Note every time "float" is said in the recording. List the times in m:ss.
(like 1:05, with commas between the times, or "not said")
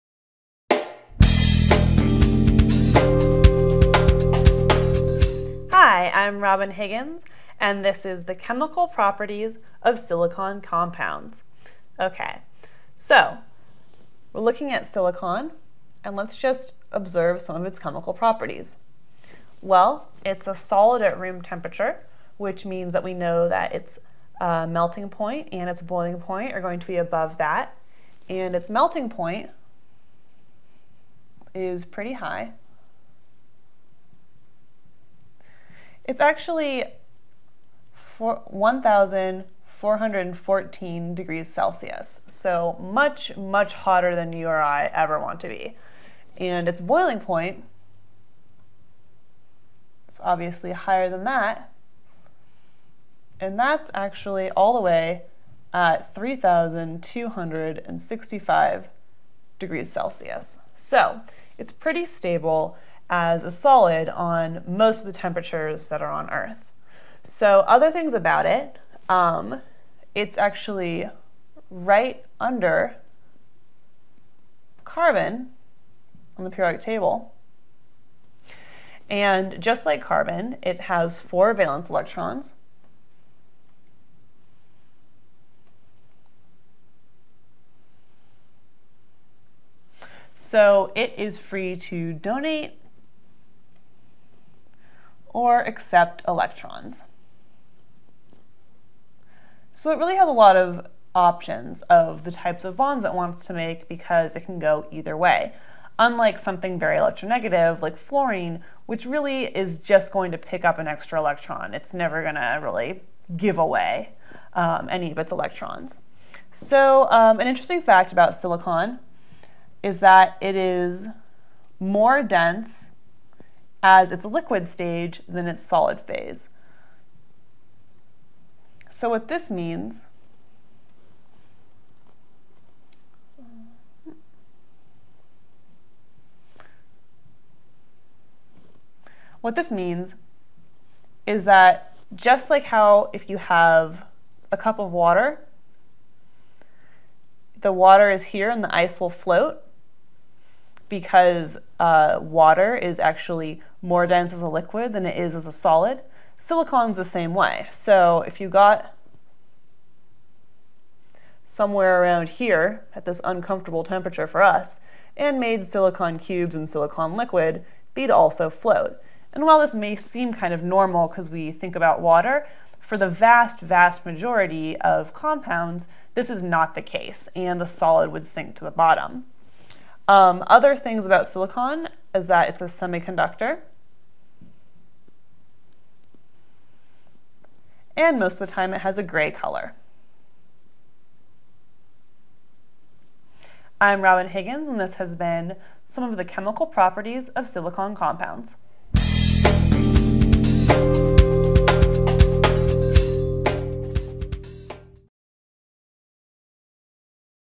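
2:29, 2:48.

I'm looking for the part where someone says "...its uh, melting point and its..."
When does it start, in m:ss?
0:23.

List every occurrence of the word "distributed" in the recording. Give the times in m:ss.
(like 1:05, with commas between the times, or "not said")
not said.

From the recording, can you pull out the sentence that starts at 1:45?
Unlike something very electronegative like fluorine, which really is just going to pick up an extra electron.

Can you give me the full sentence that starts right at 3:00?
Um, other things about silicon is that it's a semiconductor.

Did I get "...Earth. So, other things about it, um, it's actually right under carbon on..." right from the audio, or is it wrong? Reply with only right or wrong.
right.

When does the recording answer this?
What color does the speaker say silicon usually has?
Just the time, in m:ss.
3:09.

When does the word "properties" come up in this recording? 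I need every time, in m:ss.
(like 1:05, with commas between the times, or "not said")
0:08, 0:18, 3:16.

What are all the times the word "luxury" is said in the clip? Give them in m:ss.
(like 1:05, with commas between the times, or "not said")
not said.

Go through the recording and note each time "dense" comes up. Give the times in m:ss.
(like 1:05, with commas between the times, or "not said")
2:02, 2:34.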